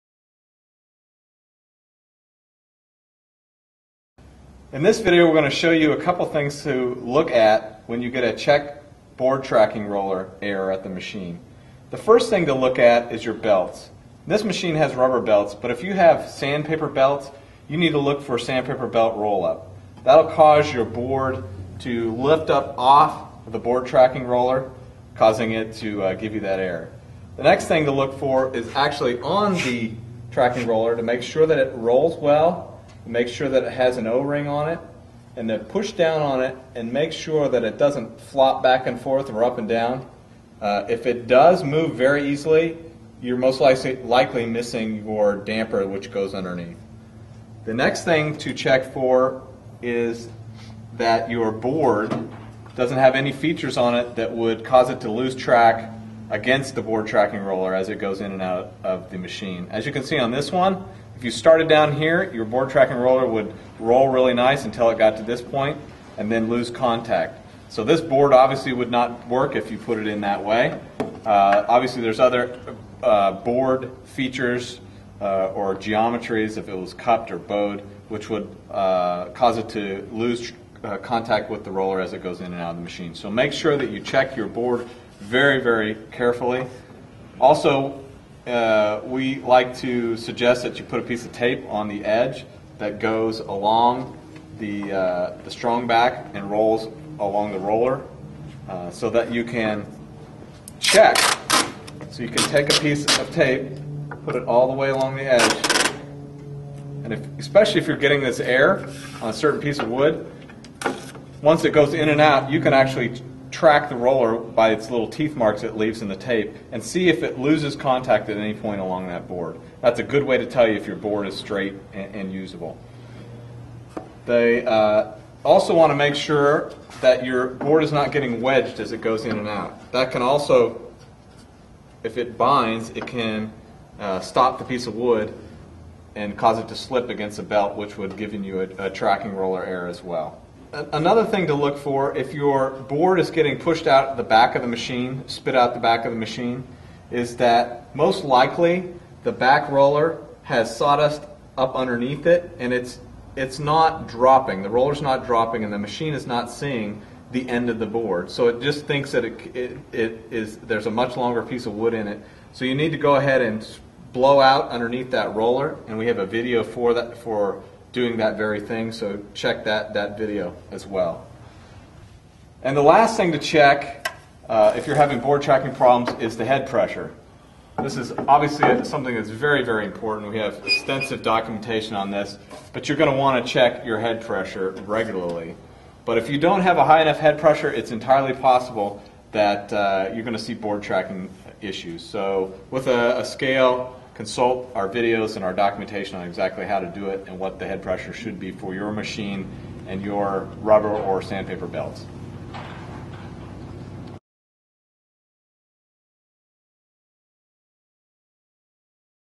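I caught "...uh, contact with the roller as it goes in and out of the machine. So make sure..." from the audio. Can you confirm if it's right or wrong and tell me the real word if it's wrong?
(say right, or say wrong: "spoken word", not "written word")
right.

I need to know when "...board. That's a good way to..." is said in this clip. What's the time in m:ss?
1:59.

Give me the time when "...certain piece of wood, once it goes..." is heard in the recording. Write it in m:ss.
1:49.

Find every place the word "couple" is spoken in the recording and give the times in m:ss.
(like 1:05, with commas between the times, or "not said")
0:05.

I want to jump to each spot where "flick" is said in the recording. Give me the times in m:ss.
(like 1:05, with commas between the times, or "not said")
not said.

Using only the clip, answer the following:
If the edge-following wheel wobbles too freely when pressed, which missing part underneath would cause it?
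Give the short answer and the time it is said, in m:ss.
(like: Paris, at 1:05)
Damper, at 0:45.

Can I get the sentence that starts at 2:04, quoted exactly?
They uh, also want to make sure that your board is not getting wedged as it goes in and out.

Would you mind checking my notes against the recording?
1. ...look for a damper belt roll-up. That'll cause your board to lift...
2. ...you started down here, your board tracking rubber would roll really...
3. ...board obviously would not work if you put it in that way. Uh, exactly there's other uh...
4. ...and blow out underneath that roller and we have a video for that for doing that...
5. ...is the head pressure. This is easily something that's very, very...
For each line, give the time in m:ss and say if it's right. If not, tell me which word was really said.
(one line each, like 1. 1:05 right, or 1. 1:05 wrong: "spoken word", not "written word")
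1. 0:17 wrong: "sandpaper", not "damper"
2. 1:01 wrong: "roller", not "rubber"
3. 1:08 wrong: "obviously", not "exactly"
4. 2:43 right
5. 2:56 wrong: "obviously", not "easily".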